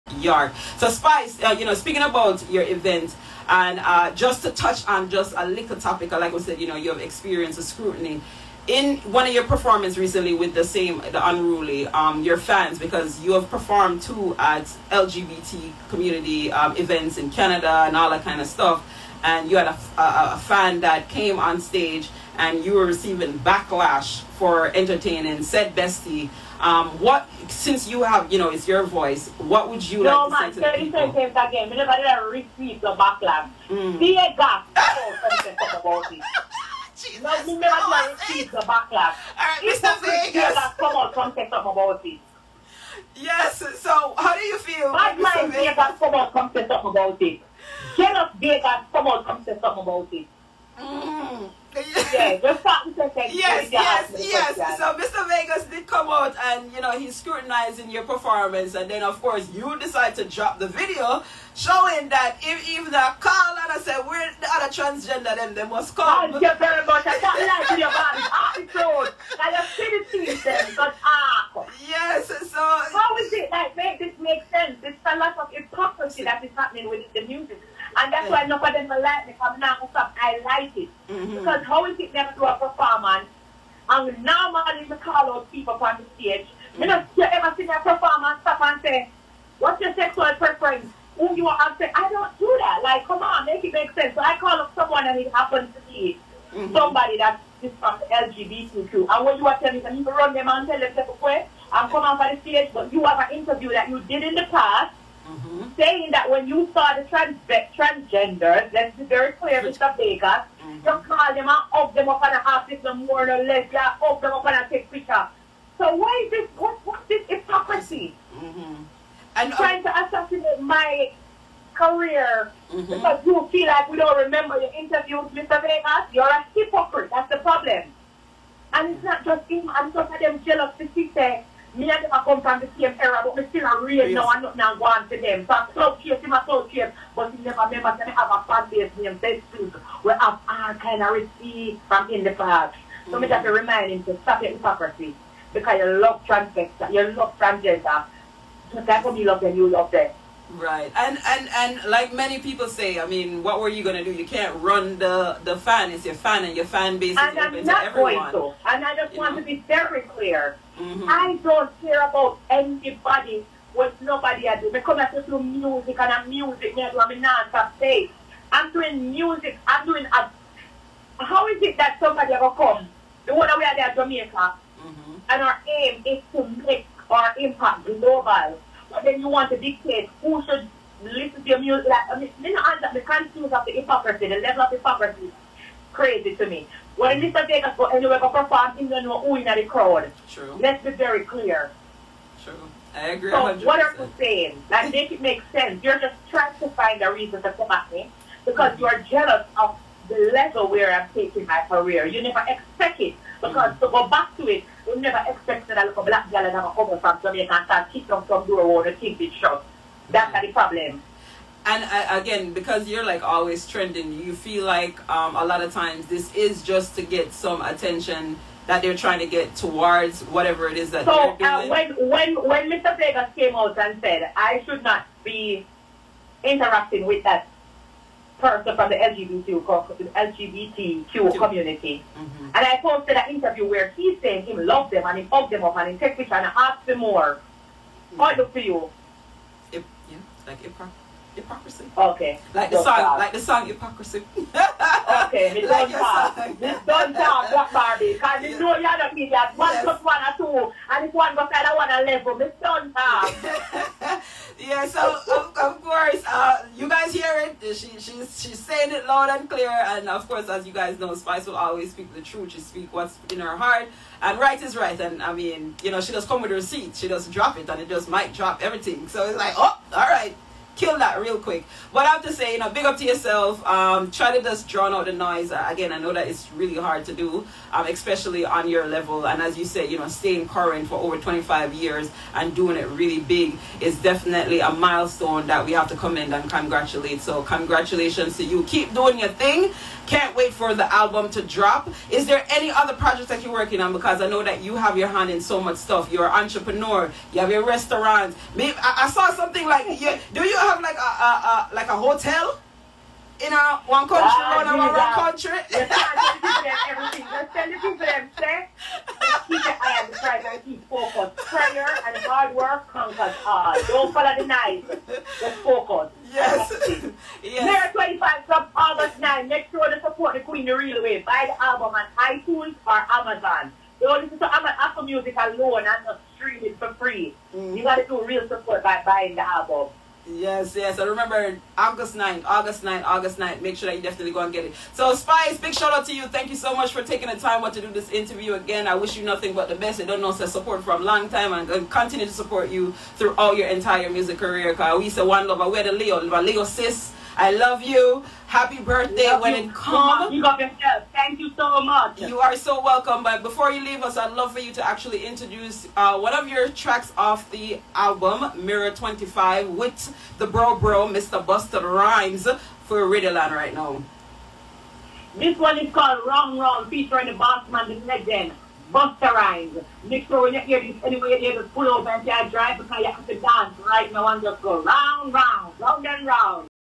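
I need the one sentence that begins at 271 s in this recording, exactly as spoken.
But I have to say, you know, big up to yourself.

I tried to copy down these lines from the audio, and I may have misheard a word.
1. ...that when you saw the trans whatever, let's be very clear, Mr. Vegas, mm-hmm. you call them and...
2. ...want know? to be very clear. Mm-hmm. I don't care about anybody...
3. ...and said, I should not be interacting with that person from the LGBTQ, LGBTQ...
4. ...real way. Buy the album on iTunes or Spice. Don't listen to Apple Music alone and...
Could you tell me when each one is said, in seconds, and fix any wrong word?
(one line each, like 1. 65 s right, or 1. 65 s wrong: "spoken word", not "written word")
1. 106 s wrong: "transgender", not "whatever"
2. 159 s right
3. 223 s right
4. 320 s wrong: "Amazon", not "Spice".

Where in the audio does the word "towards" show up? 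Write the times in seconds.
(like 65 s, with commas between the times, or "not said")
219 s.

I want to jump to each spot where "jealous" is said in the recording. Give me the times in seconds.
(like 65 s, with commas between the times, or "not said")
47 s, 130 s, 198 s.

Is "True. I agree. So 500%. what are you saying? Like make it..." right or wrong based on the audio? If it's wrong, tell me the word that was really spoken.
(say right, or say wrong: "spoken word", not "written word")
wrong: "100", not "500".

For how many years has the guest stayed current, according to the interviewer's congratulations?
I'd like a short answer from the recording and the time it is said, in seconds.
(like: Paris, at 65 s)
25 years, at 280 s.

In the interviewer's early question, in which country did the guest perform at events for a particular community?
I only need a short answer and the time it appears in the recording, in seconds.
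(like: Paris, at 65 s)
Canada, at 17 s.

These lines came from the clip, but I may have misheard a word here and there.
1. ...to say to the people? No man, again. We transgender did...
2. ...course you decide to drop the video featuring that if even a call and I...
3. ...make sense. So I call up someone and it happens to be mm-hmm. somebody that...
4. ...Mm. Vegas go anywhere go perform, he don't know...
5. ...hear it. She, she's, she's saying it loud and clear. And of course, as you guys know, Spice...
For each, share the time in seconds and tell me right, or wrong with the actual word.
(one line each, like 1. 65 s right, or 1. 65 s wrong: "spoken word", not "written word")
1. 30 s wrong: "never", not "transgender"
2. 59 s wrong: "showing", not "featuring"
3. 93 s right
4. 187 s right
5. 257 s right.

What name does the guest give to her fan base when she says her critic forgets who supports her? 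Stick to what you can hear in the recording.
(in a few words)
Best Food.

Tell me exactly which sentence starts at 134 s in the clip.
now and nothing and want to them.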